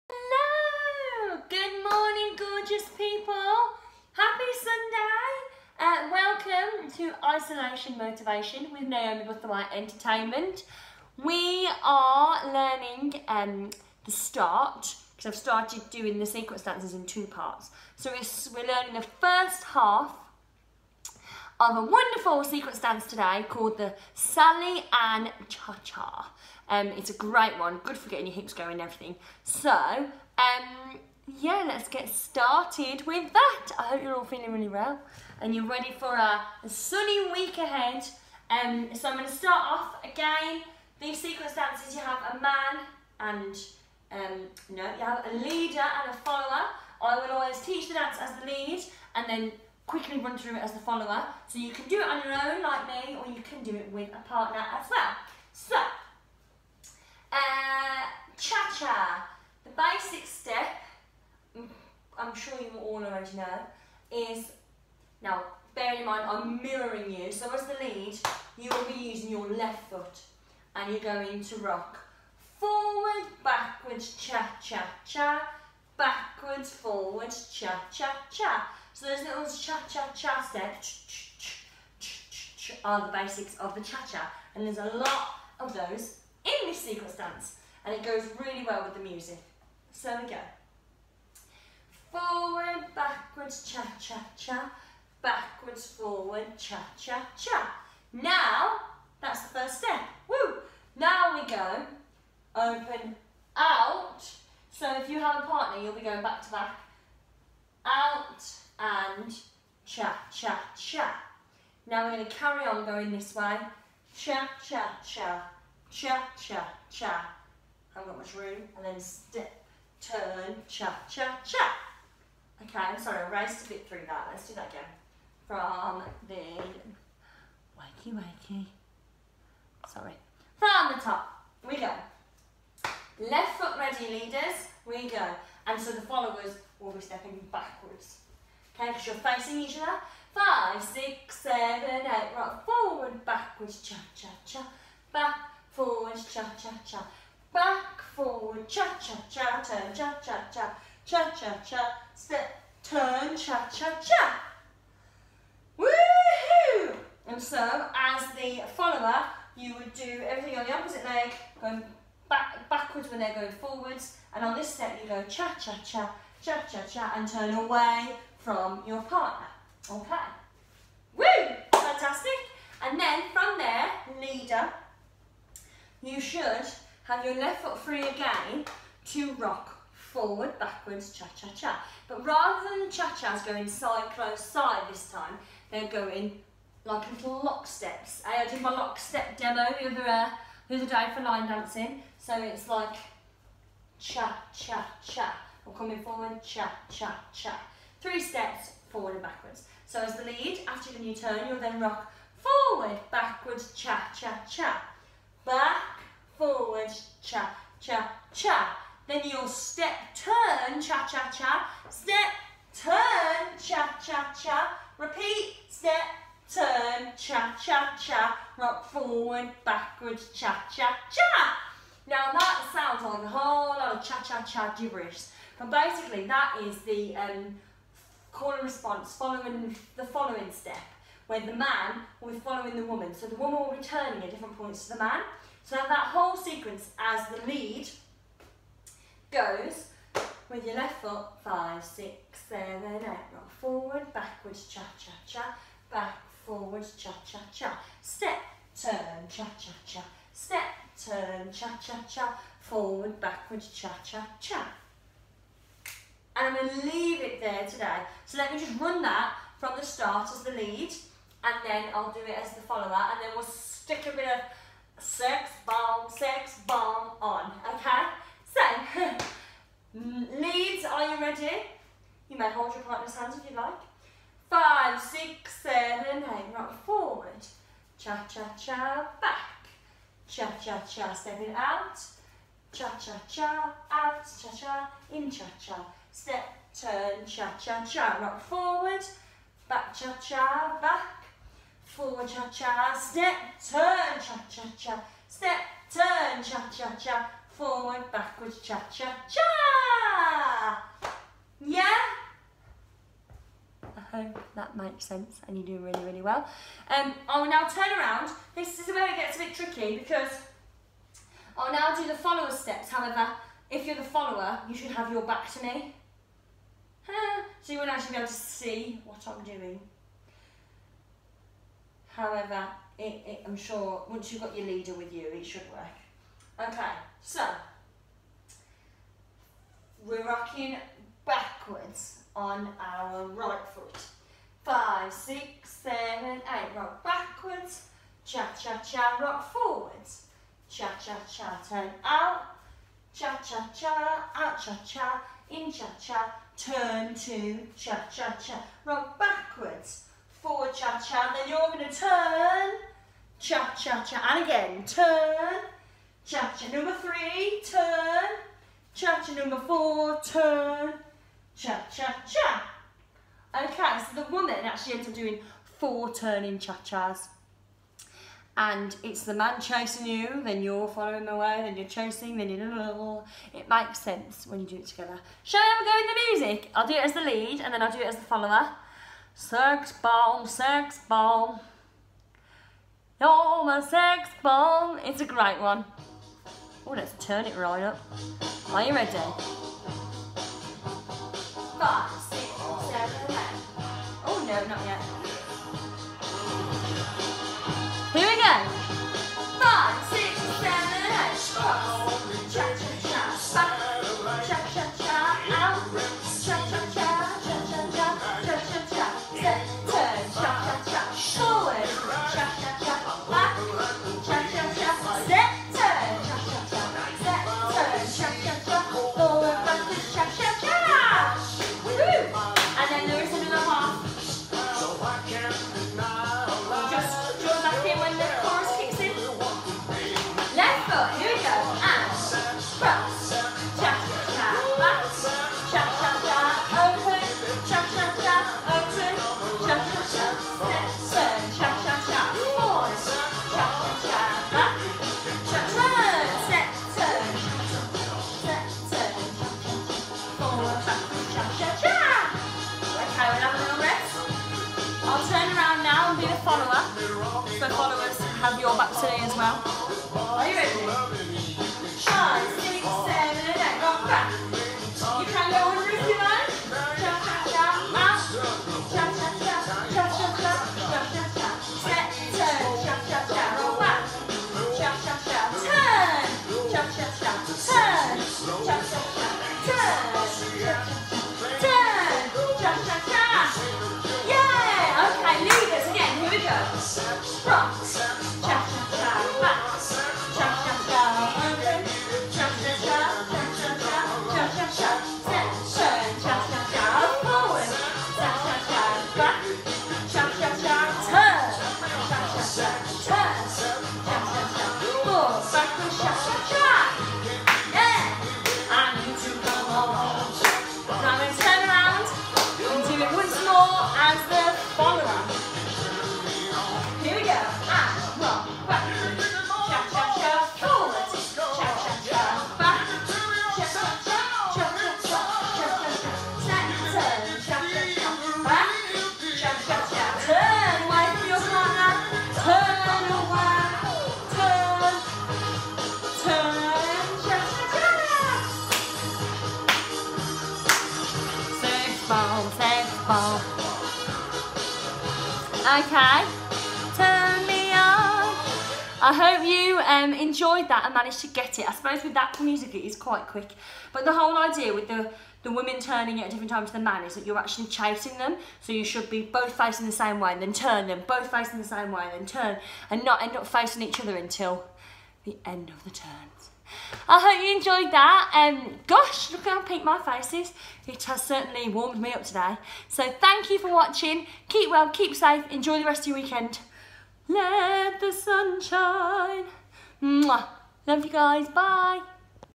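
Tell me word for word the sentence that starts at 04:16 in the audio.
And I'm going to leave it there today.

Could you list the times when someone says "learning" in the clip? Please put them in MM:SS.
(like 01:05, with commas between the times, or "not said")
00:12, 00:18.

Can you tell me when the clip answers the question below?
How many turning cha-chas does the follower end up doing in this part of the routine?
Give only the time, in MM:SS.
06:05.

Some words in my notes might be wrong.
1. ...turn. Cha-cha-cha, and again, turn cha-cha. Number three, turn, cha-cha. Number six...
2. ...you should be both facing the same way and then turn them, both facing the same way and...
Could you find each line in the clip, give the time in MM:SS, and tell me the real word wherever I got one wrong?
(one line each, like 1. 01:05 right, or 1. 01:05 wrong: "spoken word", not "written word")
1. 05:51 wrong: "four", not "six"
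2. 09:18 right.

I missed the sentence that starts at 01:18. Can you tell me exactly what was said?
So those little cha, cha, cha steps are the basics of the cha, cha.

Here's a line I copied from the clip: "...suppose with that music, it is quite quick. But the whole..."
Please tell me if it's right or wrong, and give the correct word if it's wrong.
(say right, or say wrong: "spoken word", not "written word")
right.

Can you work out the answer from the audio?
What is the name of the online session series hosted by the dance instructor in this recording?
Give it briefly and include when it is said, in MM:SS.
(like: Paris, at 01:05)
Isolation Motivation, at 00:07.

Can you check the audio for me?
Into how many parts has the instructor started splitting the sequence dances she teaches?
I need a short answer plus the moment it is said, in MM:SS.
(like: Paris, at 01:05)
2, at 00:17.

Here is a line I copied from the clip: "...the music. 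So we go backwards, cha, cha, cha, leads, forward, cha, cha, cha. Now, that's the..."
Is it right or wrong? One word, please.
wrong.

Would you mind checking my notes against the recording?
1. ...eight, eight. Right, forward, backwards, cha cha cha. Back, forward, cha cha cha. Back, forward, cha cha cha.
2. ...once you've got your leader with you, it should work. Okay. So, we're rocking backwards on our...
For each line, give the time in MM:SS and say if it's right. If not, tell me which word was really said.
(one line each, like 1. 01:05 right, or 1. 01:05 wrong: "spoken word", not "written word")
1. 02:21 wrong: "seven", not "eight"
2. 05:24 right.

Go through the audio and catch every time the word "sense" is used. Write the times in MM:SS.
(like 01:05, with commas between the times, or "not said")
05:05, 06:13.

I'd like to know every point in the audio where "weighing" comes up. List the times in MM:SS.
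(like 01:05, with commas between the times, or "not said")
not said.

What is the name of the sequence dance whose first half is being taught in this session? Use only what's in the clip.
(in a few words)
Sally Ann Cha-Cha.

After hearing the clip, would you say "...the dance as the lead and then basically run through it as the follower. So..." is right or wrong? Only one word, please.
wrong.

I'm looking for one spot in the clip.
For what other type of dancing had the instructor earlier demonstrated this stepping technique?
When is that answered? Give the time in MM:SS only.
03:11.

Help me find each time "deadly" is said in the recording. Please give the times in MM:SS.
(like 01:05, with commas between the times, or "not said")
not said.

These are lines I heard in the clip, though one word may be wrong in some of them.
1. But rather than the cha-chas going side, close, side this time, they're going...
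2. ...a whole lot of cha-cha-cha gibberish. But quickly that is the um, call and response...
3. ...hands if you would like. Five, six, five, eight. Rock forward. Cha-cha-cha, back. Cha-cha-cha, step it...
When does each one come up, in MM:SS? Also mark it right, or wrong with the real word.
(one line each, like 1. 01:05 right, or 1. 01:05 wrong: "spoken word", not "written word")
1. 03:02 right
2. 03:43 wrong: "basically", not "quickly"
3. 04:33 wrong: "seven", not "five".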